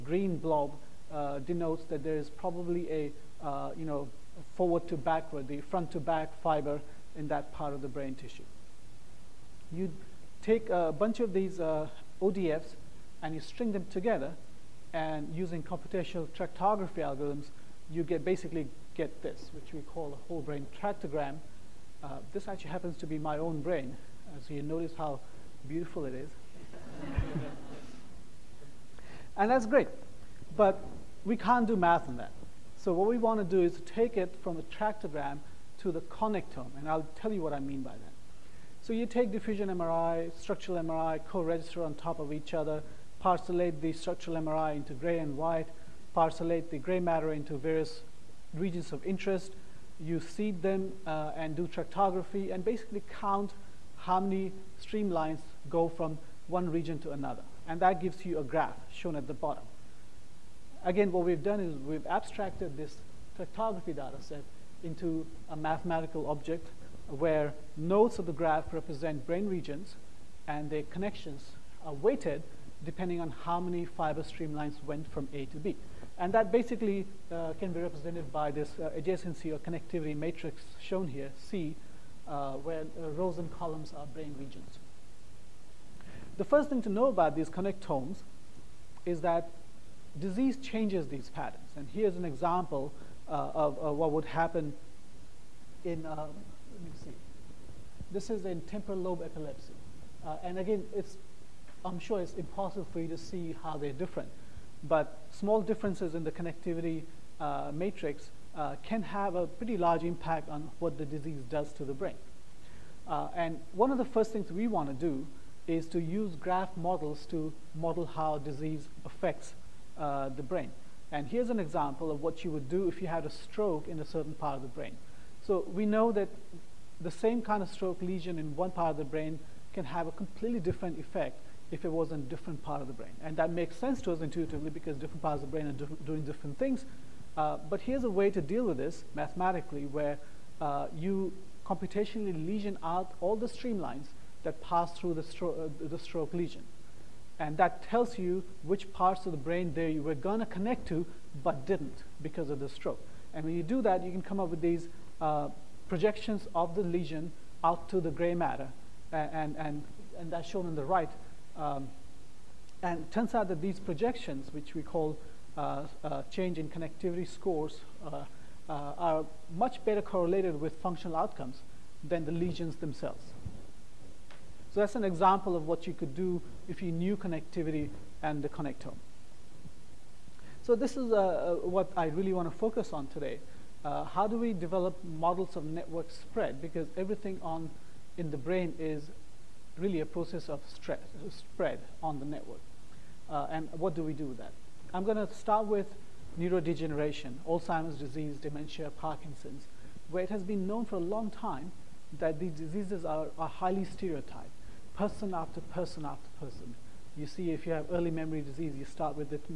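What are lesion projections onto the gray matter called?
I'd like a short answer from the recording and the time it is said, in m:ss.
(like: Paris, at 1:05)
change in connectivity scores, at 2:46.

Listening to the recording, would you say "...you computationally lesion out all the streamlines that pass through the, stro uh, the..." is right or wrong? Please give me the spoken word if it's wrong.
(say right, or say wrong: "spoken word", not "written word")
right.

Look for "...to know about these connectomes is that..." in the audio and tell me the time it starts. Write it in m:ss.
1:26.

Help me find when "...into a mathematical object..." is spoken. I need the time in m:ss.
1:04.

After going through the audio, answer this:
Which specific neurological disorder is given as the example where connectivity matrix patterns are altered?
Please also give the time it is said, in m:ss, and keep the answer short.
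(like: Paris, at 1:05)
temporal lobe epilepsy, at 1:38.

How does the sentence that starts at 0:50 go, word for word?
You seed them uh, and do tractography and basically count how many streamlines go from one region to another.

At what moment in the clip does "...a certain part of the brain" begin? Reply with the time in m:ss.
2:03.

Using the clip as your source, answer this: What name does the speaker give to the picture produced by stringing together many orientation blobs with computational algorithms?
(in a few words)
whole brain tractogram.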